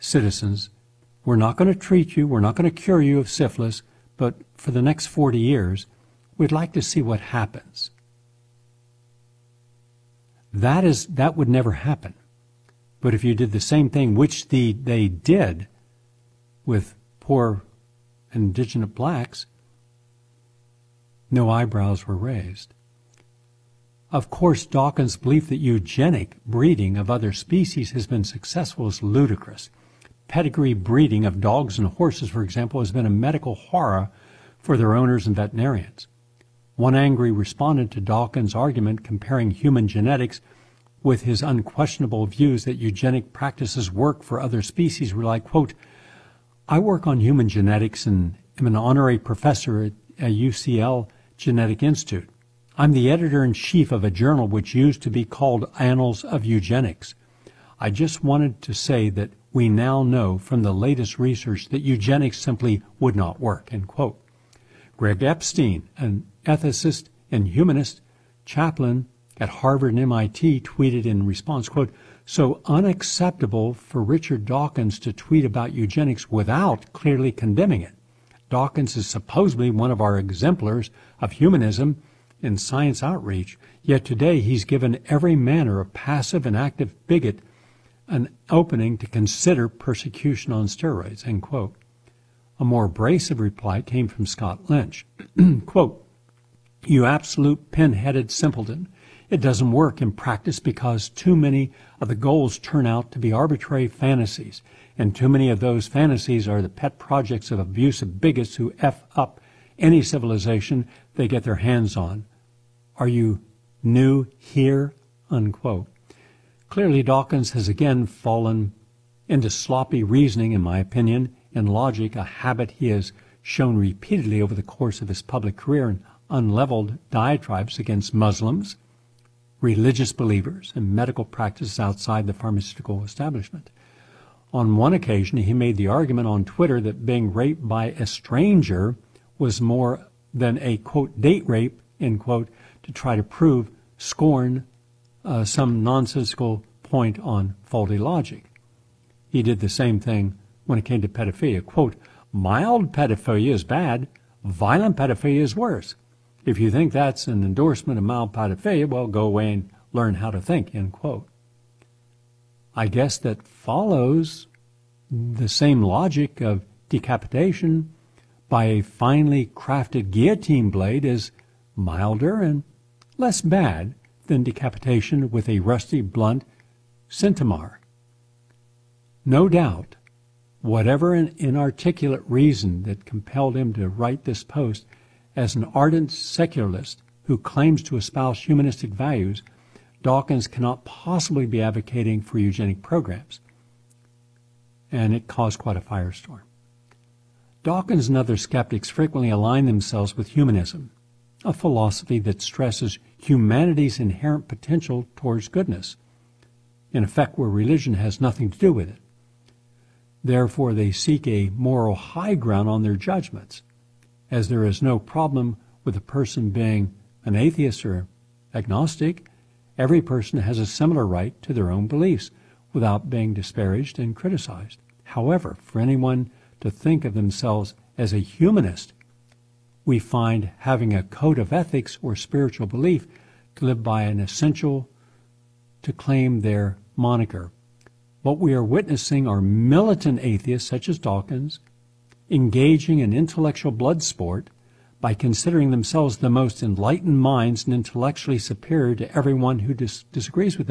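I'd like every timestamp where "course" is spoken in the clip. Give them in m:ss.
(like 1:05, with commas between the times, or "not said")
0:24, 2:04.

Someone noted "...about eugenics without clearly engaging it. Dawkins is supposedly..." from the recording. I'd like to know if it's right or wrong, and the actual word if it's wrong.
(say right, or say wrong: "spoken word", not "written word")
wrong: "condemning", not "engaging".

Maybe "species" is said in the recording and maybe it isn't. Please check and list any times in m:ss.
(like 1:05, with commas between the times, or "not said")
0:27, 0:44.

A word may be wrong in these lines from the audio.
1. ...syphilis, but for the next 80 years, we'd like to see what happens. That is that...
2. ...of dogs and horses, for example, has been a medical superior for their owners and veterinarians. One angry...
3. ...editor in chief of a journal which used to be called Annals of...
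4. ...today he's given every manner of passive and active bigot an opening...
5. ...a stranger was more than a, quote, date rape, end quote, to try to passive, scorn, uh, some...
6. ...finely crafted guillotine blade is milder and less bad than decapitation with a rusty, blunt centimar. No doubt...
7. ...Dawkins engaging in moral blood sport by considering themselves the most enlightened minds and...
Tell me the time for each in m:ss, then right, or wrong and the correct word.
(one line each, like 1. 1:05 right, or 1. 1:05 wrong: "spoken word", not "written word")
1. 0:03 wrong: "40", not "80"
2. 0:31 wrong: "horror", not "superior"
3. 0:53 right
4. 1:24 right
5. 2:17 wrong: "prove", not "passive"
6. 2:48 right
7. 4:00 wrong: "intellectual", not "moral".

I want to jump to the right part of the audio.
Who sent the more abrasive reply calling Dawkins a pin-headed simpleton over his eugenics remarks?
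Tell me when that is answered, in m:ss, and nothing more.
1:34.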